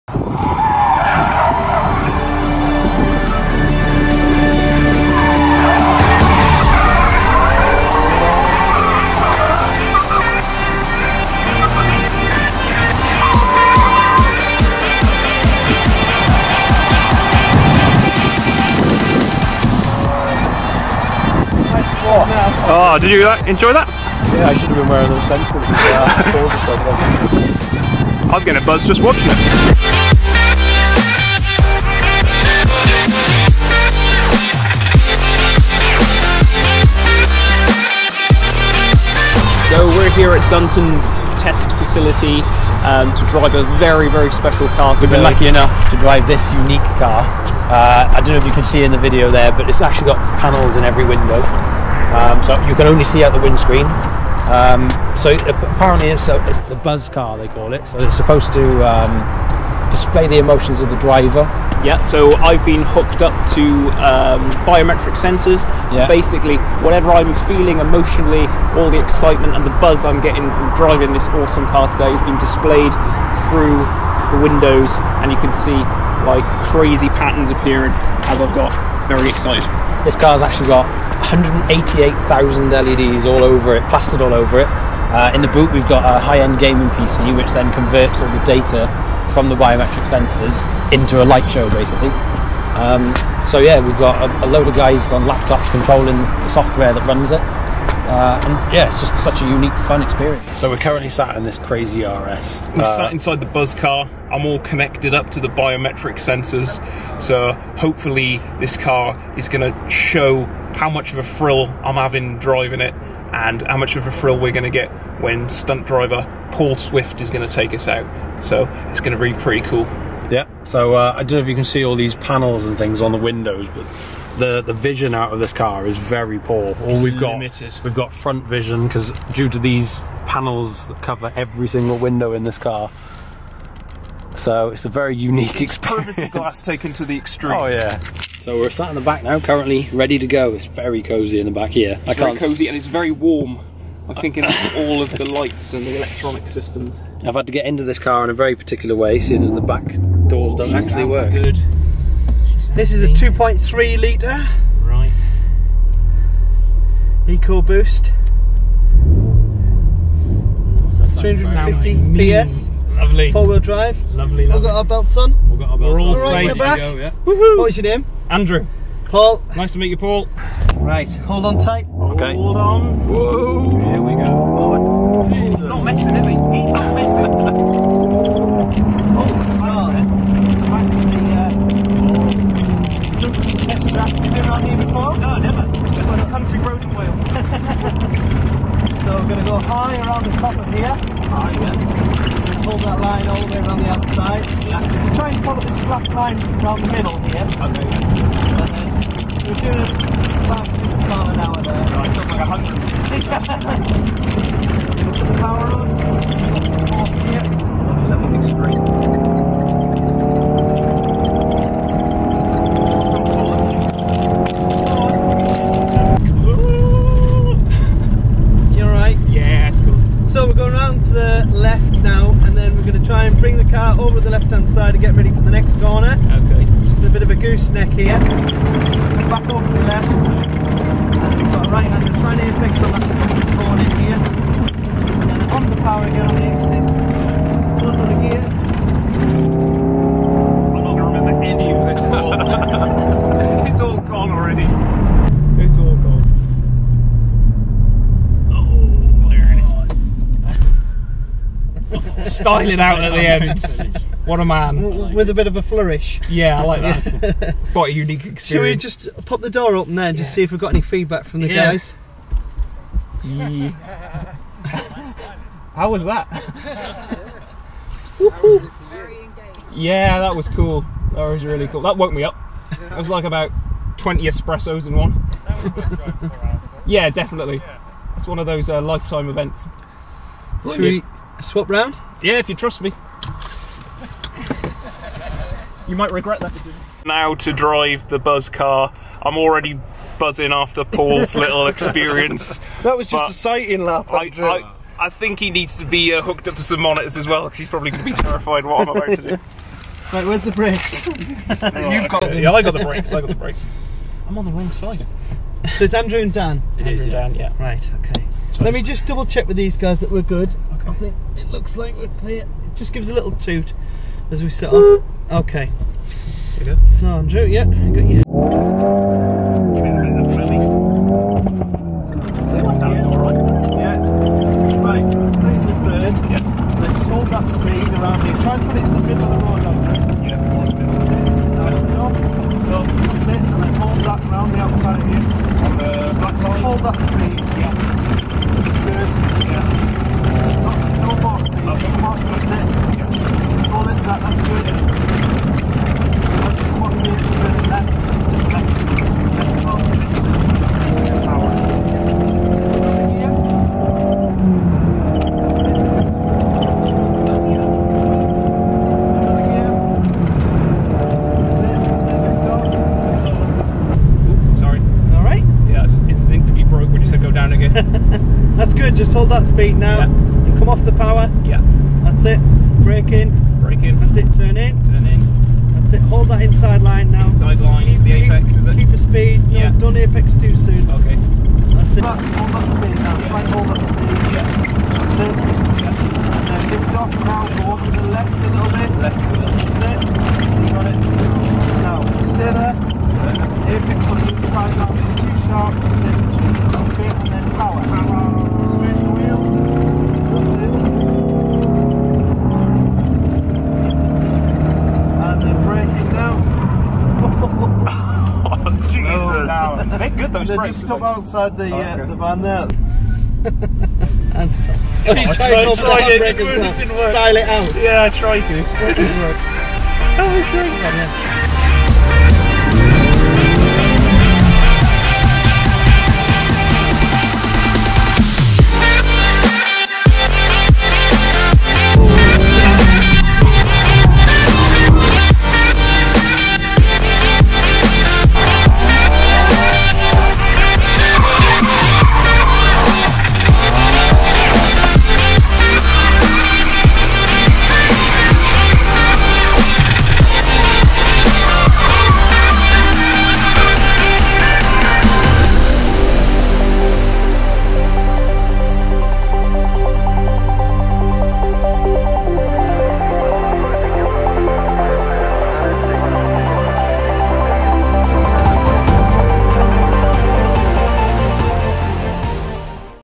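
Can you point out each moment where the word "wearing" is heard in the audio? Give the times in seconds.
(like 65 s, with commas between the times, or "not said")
24 s.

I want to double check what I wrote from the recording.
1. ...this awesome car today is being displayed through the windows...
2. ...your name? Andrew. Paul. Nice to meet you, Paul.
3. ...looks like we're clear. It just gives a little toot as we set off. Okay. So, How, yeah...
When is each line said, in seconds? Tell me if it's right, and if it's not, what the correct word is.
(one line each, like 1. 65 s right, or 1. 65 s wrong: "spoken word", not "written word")
1. 71 s right
2. 167 s right
3. 311 s wrong: "Andrew", not "How".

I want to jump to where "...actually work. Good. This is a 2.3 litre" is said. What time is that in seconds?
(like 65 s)
150 s.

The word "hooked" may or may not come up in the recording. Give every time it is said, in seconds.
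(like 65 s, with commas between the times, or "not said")
62 s, 296 s.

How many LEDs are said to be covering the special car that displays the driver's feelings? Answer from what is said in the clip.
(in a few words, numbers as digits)
188,000.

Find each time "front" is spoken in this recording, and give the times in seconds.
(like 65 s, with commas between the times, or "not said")
128 s, 232 s.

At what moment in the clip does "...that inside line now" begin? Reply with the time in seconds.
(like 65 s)
376 s.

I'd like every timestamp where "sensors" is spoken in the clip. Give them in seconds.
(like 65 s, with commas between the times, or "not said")
25 s, 65 s, 90 s, 106 s.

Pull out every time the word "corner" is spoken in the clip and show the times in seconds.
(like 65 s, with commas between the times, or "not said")
225 s, 233 s.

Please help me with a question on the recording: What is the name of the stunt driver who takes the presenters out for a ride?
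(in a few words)
Paul Swift.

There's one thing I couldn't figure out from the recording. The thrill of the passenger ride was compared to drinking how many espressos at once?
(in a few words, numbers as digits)
20.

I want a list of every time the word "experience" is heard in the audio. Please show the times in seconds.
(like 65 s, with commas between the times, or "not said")
100 s, 135 s, 258 s, 291 s.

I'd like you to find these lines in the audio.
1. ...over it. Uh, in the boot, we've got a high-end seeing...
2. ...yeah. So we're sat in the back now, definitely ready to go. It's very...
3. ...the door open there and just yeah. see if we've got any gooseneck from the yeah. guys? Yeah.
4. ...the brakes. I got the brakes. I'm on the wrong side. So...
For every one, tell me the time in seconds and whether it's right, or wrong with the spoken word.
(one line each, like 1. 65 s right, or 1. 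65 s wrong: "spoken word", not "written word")
1. 84 s wrong: "gaming", not "seeing"
2. 137 s wrong: "currently", not "definitely"
3. 259 s wrong: "feedback", not "gooseneck"
4. 302 s right.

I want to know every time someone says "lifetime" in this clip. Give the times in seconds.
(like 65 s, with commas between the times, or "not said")
278 s.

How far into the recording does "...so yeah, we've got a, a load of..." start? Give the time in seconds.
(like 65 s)
93 s.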